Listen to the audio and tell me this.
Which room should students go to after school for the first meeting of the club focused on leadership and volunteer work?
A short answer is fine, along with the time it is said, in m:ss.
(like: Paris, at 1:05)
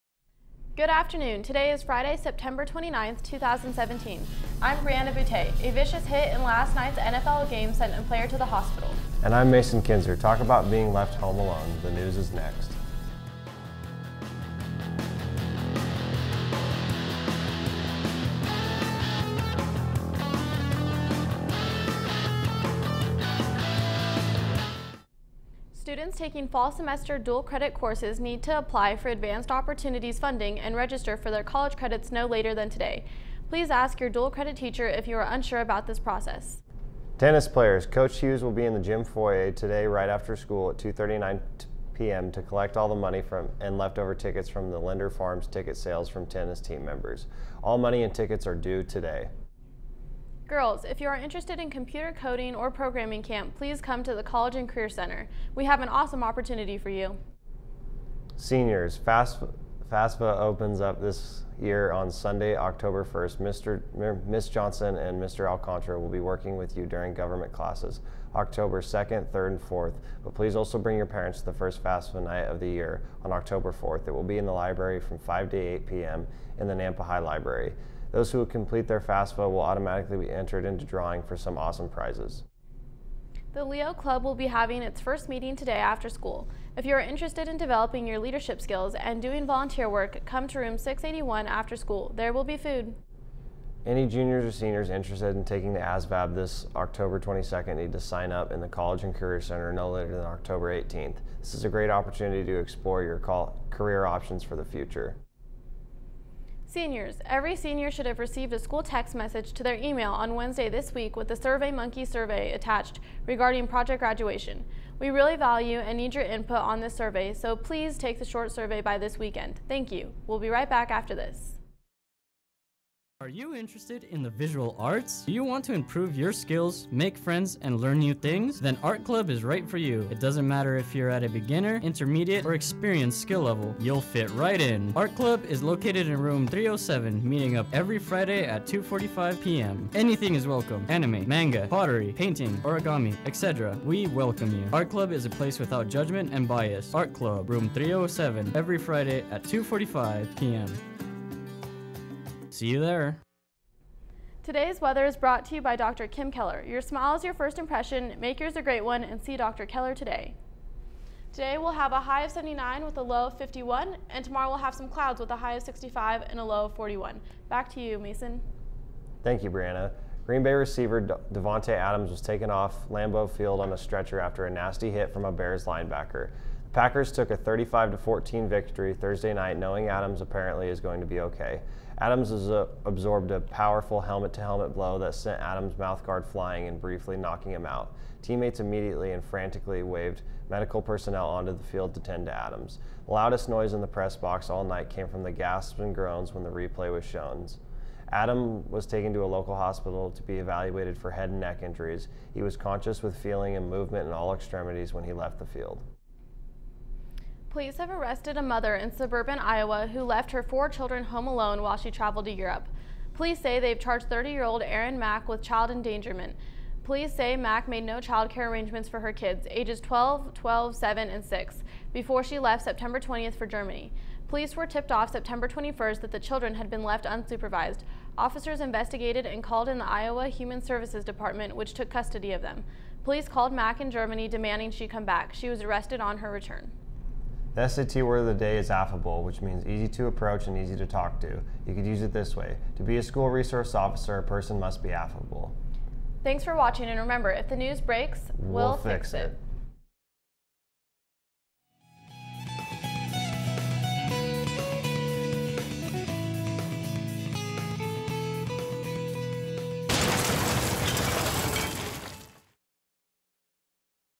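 681, at 1:30.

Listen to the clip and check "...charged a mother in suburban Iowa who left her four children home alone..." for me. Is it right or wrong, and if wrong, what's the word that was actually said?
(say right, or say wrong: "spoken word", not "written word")
wrong: "arrested", not "charged".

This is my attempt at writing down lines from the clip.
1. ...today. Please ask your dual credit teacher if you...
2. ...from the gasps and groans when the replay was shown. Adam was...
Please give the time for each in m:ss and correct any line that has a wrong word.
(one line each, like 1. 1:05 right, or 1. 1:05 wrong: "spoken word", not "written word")
1. 0:32 right
2. 3:15 right.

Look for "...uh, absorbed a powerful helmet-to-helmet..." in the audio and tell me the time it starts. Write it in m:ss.
3:02.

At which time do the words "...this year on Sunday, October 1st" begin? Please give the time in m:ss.
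1:01.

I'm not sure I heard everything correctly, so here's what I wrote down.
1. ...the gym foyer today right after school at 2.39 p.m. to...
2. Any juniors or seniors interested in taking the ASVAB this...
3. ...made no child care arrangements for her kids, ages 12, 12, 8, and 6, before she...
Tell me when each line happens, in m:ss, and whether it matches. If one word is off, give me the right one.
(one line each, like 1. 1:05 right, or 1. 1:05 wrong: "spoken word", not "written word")
1. 0:38 right
2. 1:33 right
3. 3:37 wrong: "7", not "8".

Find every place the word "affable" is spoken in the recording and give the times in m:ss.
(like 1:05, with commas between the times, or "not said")
3:58, 4:04.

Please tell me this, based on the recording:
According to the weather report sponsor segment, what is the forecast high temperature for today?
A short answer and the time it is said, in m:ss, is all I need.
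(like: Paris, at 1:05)
79, at 2:42.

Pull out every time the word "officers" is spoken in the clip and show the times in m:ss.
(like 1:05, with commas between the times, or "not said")
3:48, 4:03.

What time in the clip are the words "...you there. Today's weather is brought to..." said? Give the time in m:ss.
2:32.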